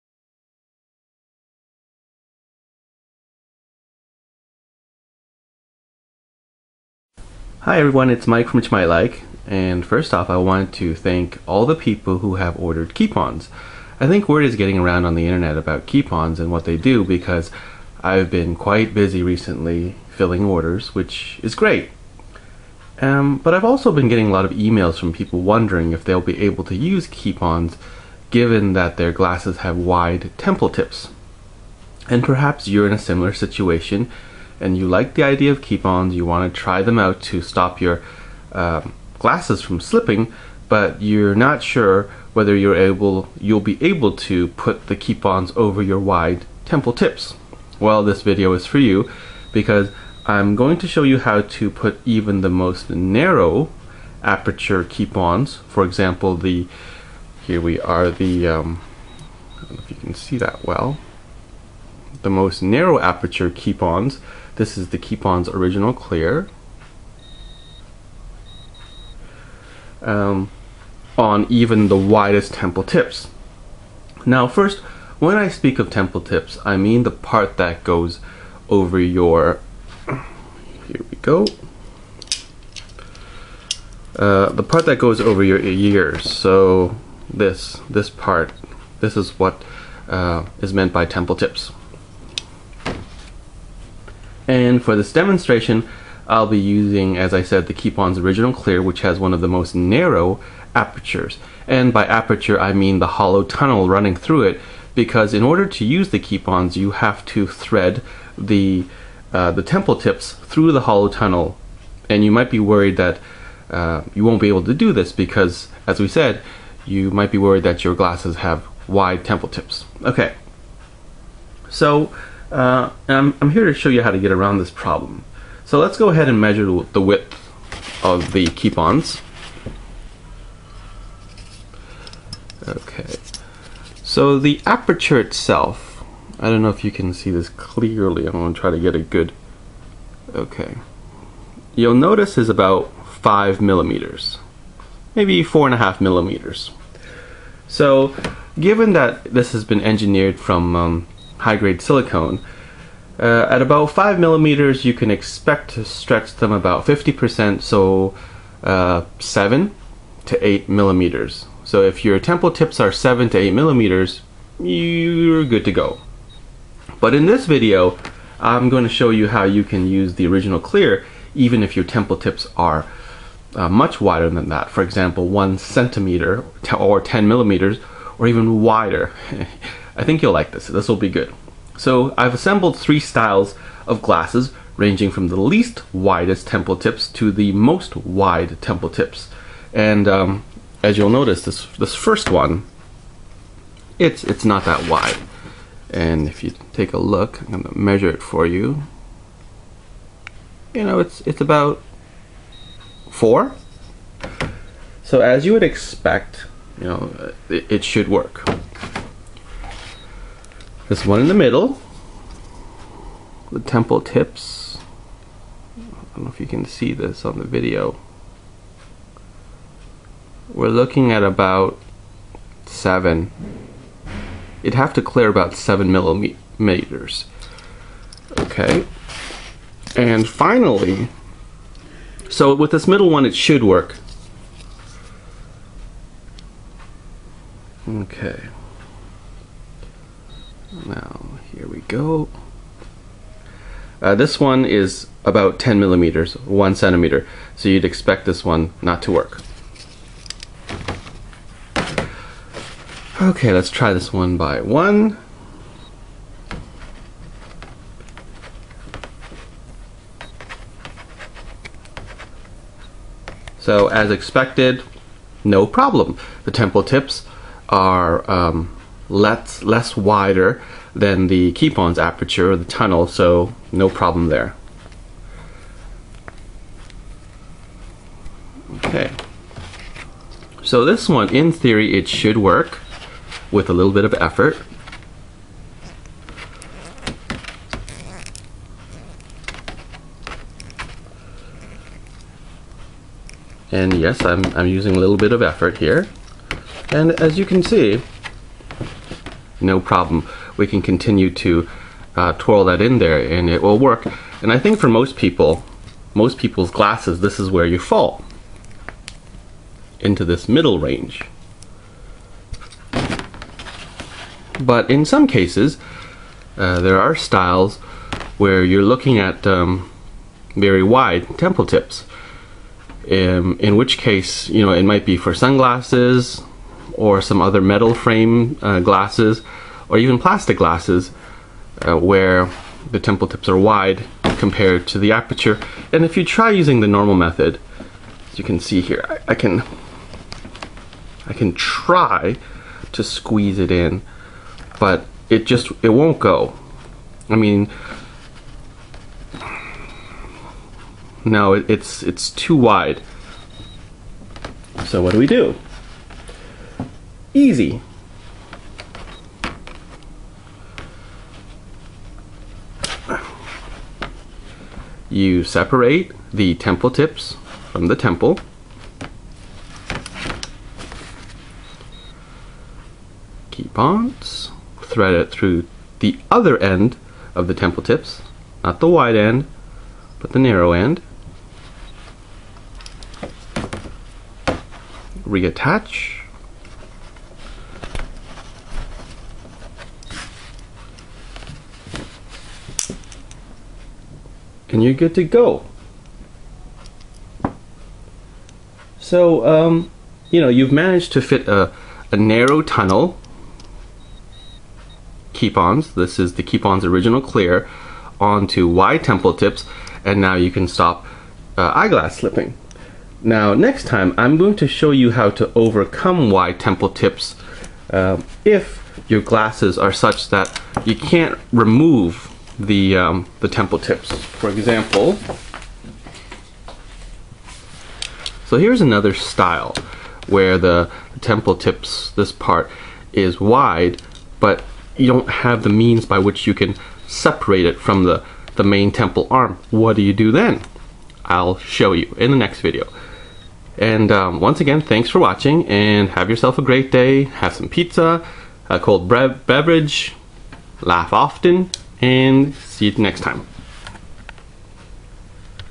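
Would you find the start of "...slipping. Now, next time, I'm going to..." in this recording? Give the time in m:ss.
6:52.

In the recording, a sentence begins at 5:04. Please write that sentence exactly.
And I think for most people, most people's glasses, this is where you fall into this middle range.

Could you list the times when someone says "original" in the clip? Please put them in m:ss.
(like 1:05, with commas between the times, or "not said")
1:05, 1:38, 2:50, 6:46.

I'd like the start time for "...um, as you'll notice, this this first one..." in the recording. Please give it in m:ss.
3:10.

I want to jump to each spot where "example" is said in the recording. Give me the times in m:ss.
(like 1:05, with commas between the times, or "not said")
0:55, 2:54, 7:04.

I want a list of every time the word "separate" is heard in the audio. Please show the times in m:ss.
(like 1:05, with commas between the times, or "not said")
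6:05, 7:17.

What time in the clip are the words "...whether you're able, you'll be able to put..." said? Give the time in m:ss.
0:42.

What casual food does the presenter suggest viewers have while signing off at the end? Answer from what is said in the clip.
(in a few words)
pizza.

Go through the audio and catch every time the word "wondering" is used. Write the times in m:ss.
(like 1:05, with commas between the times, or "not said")
0:25.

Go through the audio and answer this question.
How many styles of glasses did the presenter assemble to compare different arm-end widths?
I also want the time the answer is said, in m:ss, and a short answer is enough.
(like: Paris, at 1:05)
3, at 3:02.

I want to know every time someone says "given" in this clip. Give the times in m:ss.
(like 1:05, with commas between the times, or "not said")
0:28, 2:28.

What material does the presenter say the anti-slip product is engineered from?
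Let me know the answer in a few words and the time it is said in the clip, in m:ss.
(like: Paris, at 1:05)
high grade silicone, at 2:31.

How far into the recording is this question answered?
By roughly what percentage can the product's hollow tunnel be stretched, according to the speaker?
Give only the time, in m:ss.
2:36.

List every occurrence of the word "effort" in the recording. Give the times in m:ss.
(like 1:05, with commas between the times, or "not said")
4:44, 4:55.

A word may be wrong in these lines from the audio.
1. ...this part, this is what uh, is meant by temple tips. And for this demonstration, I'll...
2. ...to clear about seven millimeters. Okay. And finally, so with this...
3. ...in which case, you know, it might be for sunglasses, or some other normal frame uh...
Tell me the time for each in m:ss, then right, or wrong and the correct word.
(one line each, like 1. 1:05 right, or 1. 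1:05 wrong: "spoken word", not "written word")
1. 1:27 right
2. 3:44 right
3. 5:23 wrong: "metal", not "normal".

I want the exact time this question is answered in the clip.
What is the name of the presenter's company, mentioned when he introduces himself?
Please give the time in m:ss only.
0:08.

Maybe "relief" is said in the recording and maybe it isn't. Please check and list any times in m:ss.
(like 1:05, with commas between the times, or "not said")
not said.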